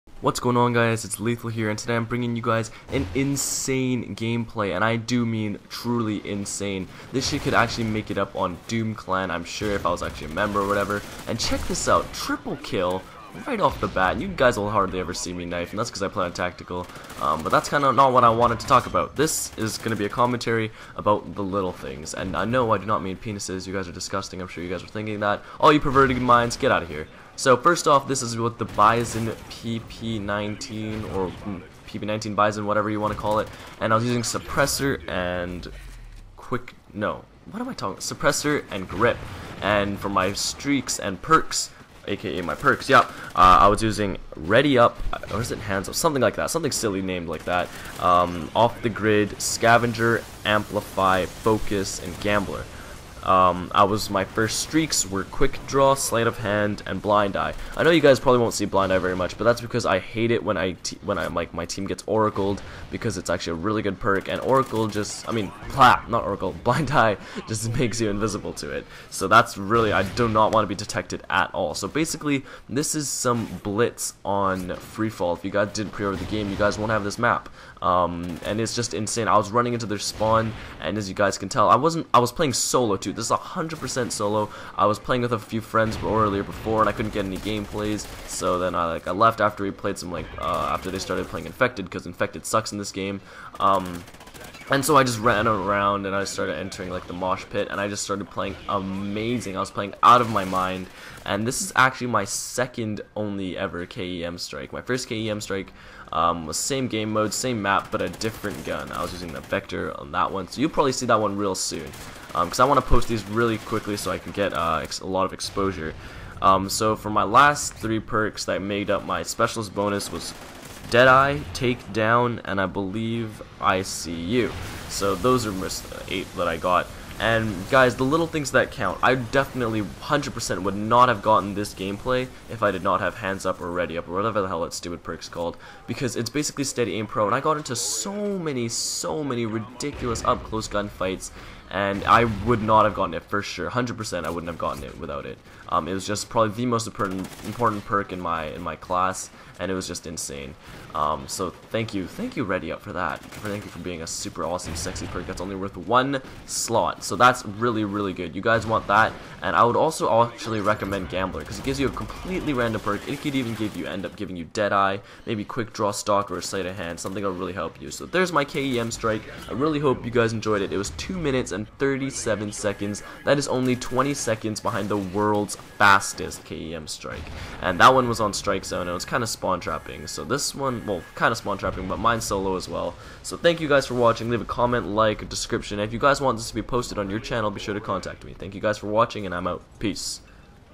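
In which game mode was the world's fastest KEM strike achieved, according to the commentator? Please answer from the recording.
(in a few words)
Strike Zone.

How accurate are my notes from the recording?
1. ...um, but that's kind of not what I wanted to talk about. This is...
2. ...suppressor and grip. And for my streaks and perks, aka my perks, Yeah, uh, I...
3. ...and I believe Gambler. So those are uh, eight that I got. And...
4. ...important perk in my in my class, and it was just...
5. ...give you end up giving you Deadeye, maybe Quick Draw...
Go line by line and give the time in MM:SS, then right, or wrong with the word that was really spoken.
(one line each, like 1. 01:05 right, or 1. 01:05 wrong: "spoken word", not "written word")
1. 00:17 right
2. 00:37 right
3. 02:02 wrong: "ICU", not "Gambler"
4. 02:26 right
5. 02:43 right.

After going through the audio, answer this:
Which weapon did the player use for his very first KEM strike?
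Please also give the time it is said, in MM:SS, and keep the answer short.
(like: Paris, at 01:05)
Vector, at 01:49.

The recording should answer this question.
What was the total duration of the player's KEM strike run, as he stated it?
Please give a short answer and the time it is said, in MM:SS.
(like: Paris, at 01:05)
2 minutes 37 seconds, at 02:50.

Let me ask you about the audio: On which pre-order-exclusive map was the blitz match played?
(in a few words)
Freefall.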